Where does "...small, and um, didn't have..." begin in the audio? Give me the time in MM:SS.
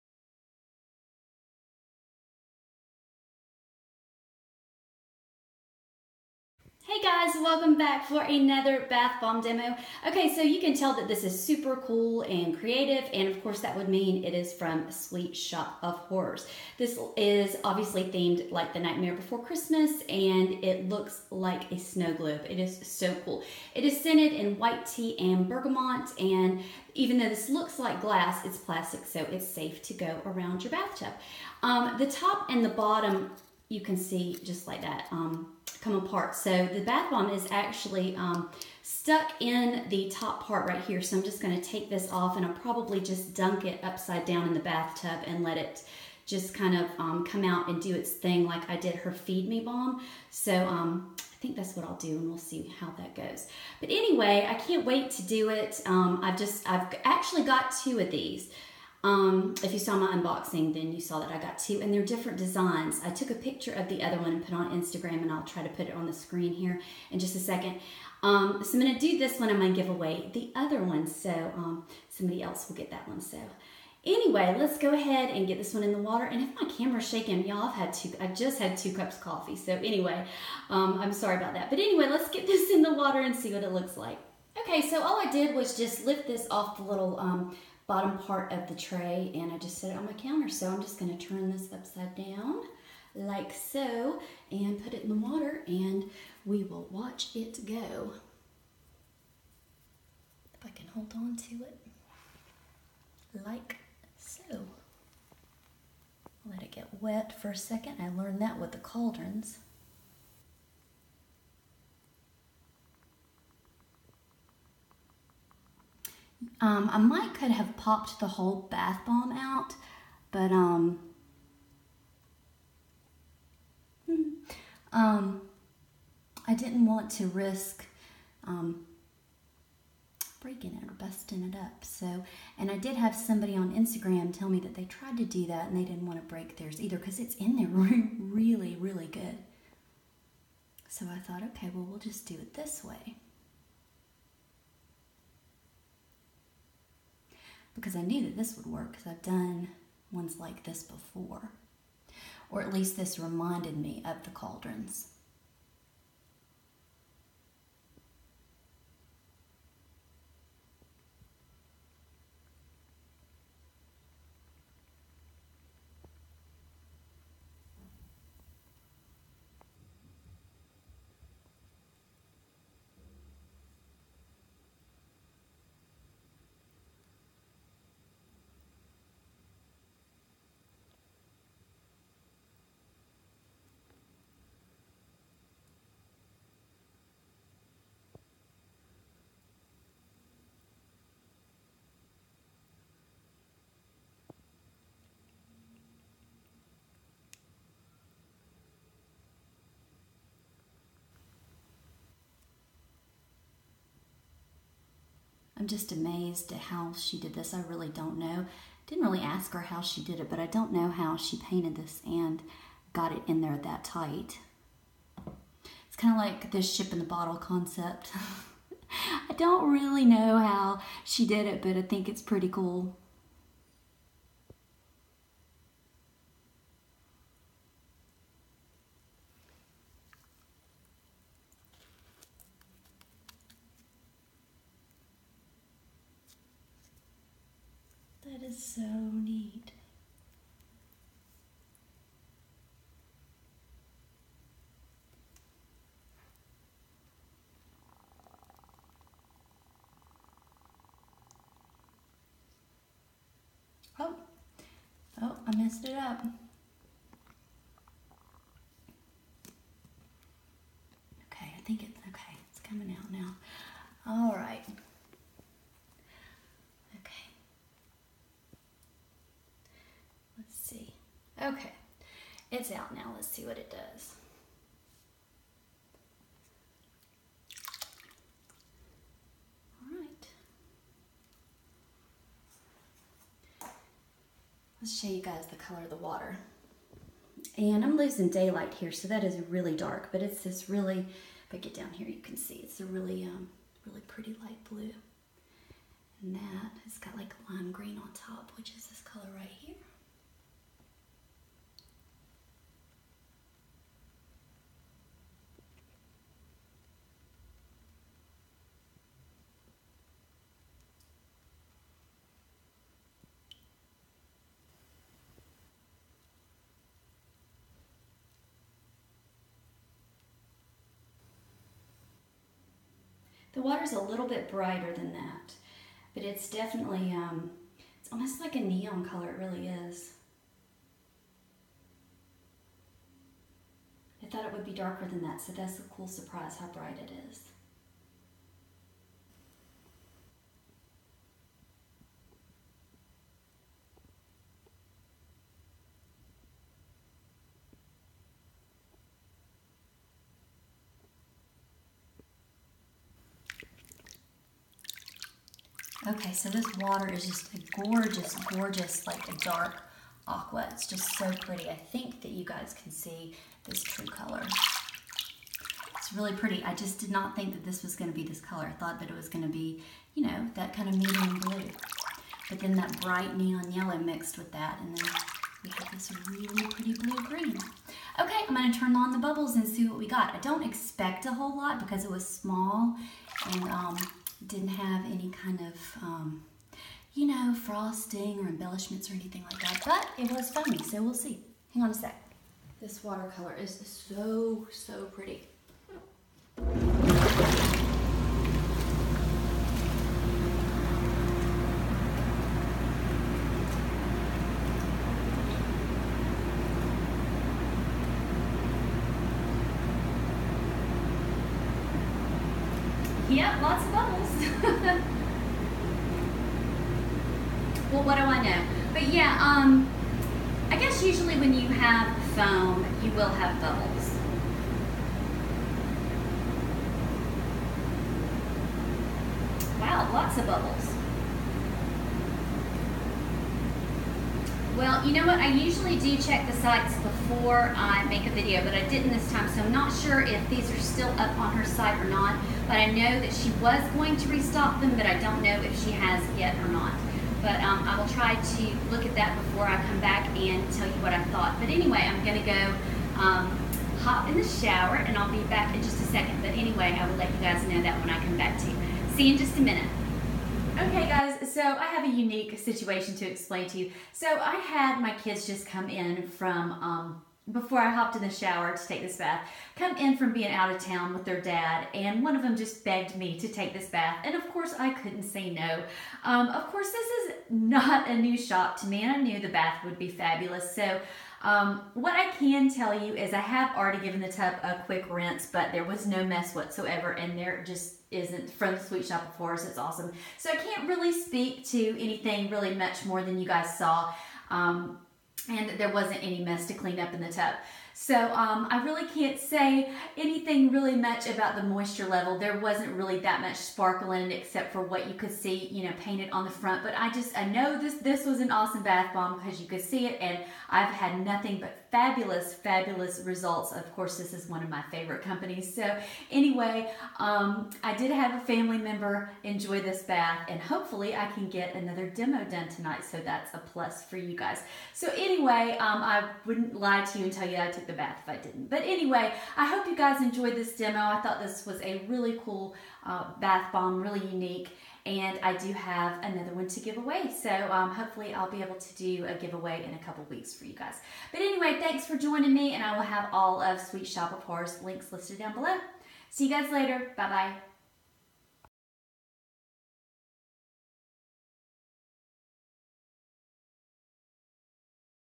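06:22.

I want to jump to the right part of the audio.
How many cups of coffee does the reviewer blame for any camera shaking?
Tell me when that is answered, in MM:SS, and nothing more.
01:18.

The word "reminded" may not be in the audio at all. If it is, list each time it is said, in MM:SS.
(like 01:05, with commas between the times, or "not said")
02:33.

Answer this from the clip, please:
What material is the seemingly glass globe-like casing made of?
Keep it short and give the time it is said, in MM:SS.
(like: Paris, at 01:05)
Plastic, at 00:28.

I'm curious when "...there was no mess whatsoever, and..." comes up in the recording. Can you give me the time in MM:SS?
08:05.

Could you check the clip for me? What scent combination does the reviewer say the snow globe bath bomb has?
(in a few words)
White tea and bergamot.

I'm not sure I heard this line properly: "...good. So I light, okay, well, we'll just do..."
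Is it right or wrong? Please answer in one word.
wrong.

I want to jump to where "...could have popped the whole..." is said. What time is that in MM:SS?
01:57.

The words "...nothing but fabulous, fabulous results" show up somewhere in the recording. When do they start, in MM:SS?
08:31.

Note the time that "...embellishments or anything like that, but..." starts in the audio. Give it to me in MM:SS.
06:28.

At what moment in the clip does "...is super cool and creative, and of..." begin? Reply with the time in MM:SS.
00:11.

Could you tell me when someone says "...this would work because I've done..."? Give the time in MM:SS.
02:28.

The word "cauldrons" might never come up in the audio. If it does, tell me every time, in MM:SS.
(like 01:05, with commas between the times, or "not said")
01:48, 02:34.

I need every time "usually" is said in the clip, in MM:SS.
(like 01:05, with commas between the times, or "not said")
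07:01, 07:15.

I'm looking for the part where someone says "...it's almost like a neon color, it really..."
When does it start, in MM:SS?
05:27.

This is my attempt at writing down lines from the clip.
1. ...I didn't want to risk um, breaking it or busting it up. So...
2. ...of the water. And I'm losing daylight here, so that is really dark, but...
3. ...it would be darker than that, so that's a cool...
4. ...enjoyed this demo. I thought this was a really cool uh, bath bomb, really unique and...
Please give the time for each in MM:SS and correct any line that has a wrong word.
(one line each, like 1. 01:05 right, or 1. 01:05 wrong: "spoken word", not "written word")
1. 02:06 right
2. 04:45 right
3. 05:34 right
4. 08:50 right.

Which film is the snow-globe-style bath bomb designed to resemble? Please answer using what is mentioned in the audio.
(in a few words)
The Nightmare Before Christmas.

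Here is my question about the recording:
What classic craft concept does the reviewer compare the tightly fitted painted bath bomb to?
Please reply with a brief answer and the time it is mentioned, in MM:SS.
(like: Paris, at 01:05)
Ship in the bottle, at 03:36.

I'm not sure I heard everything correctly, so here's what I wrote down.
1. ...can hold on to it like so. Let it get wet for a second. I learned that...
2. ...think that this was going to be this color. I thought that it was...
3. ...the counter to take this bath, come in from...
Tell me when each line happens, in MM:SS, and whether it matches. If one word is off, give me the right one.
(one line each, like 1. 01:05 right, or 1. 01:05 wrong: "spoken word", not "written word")
1. 01:40 right
2. 06:07 right
3. 07:48 wrong: "shower", not "counter".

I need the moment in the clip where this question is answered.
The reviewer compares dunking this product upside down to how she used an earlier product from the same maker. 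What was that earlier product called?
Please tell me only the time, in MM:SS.
00:49.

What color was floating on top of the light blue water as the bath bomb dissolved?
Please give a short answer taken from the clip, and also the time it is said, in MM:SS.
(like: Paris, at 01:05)
Lime green, at 04:57.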